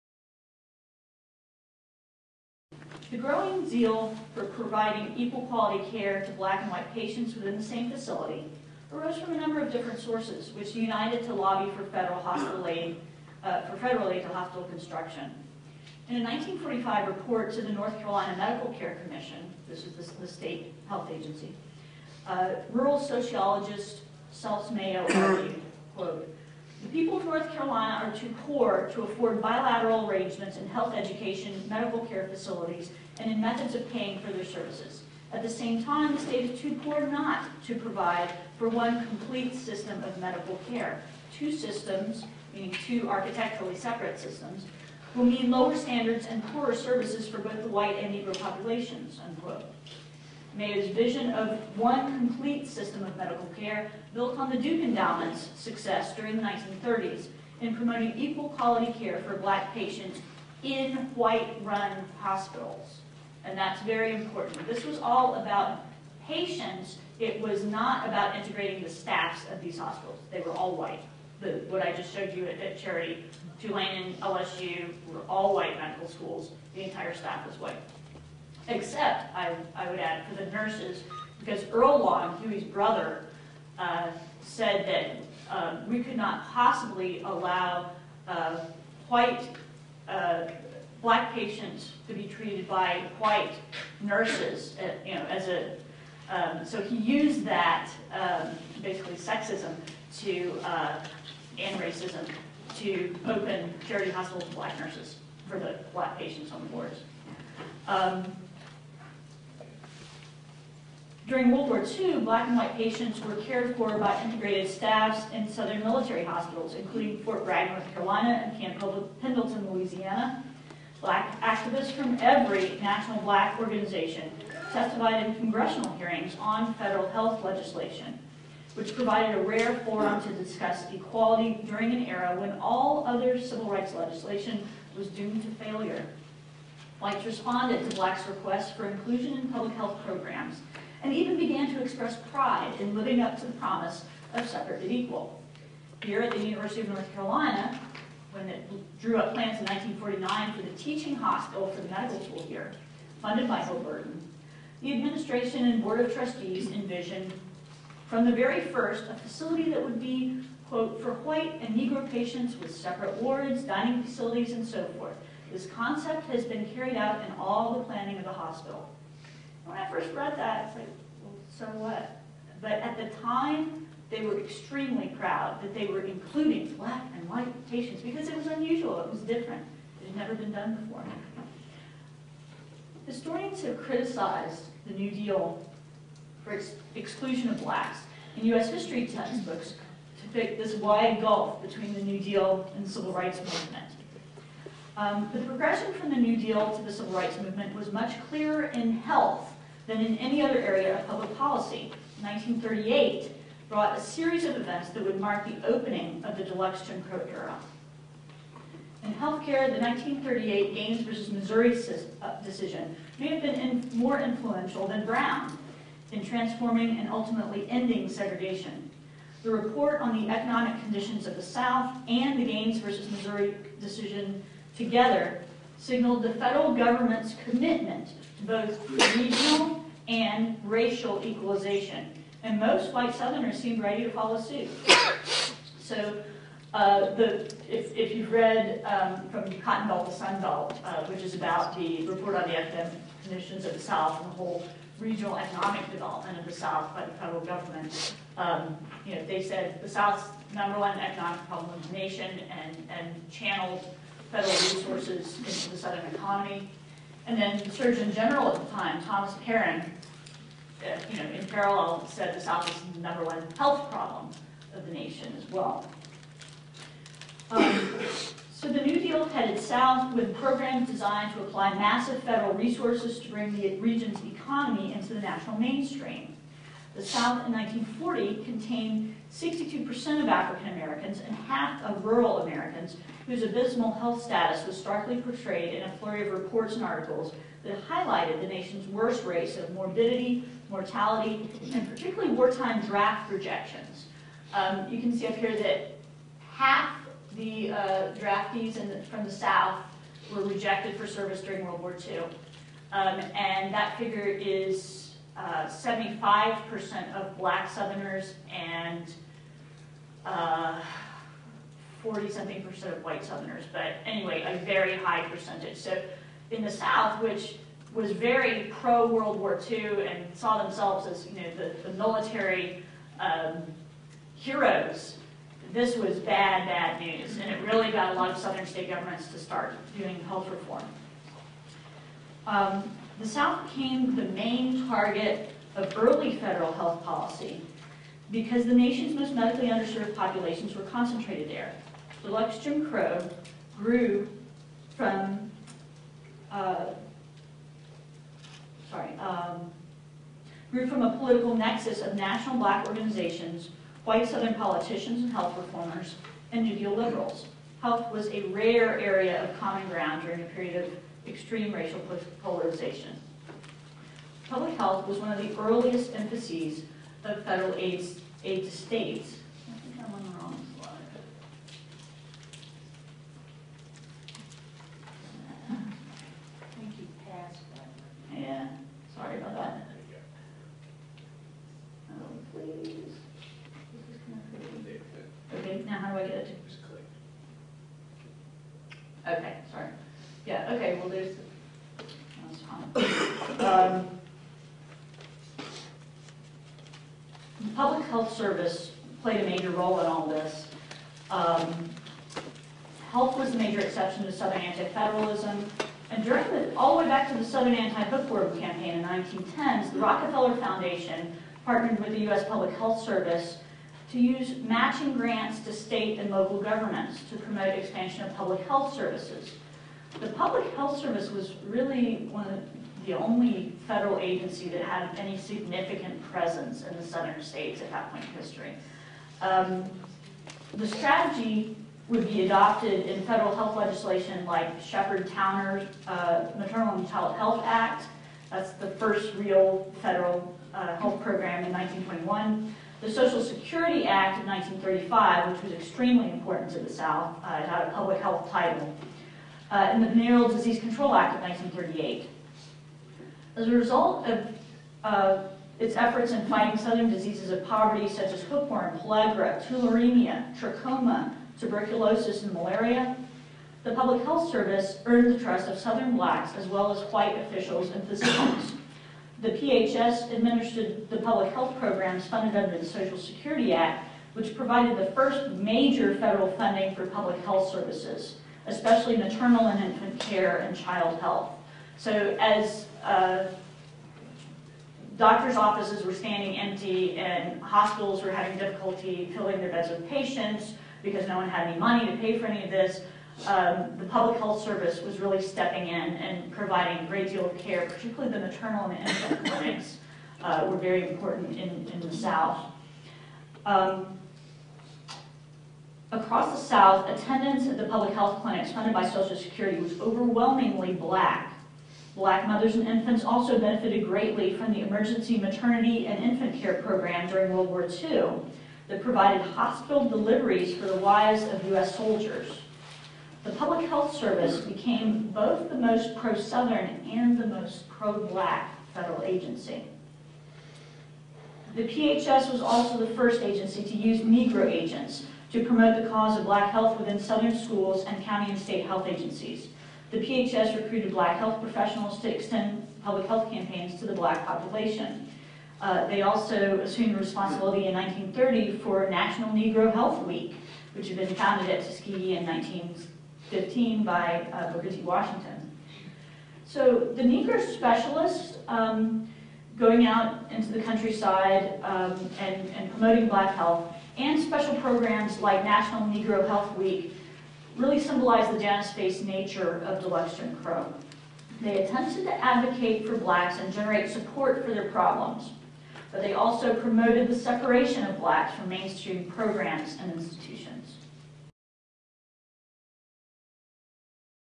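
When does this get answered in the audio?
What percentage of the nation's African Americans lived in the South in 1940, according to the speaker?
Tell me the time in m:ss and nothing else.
4:39.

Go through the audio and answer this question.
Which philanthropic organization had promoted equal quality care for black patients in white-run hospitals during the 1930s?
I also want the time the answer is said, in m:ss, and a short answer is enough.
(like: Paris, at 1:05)
Duke Endowment, at 0:54.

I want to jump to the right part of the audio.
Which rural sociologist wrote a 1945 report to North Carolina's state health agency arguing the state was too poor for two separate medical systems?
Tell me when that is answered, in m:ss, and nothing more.
0:24.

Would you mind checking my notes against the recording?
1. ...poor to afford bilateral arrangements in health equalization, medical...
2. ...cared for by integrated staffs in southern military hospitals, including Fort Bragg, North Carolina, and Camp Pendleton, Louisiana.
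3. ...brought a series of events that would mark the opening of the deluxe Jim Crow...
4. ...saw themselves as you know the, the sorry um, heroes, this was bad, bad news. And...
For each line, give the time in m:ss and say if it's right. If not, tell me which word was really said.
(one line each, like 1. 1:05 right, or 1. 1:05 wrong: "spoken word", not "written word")
1. 0:28 wrong: "education", not "equalization"
2. 1:53 right
3. 3:23 right
4. 5:20 wrong: "military", not "sorry".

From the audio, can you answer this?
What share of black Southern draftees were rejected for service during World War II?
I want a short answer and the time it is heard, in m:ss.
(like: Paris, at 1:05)
75%, at 5:05.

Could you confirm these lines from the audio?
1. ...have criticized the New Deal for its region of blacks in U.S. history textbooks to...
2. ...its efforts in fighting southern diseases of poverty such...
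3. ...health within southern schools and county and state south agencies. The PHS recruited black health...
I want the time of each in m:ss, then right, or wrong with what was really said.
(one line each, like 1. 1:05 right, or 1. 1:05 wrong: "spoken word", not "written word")
1. 3:03 wrong: "exclusion", not "region"
2. 7:35 right
3. 8:56 wrong: "health", not "south".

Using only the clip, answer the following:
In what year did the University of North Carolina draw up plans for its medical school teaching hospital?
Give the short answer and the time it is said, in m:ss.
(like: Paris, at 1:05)
1949, at 2:29.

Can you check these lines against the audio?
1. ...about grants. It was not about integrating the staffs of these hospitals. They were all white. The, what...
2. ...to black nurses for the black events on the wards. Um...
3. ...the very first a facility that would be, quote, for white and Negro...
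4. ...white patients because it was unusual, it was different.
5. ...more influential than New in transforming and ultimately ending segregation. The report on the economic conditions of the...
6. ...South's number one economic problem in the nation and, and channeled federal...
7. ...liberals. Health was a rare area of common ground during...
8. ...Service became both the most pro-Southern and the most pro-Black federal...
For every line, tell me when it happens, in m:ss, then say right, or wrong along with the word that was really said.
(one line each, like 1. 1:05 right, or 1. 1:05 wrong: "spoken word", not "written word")
1. 1:05 wrong: "patients", not "grants"
2. 1:44 wrong: "patients", not "events"
3. 2:38 right
4. 2:57 right
5. 3:33 wrong: "Brown", not "New"
6. 4:09 right
7. 5:56 right
8. 8:44 right.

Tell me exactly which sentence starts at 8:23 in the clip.
Um, Across the South, attendance at the public health clinics funded by Social Security was overwhelmingly black.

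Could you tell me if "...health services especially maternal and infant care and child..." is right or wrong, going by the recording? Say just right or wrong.
right.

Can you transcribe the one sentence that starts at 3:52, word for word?
And most white Southerners seemed ready to follow suit.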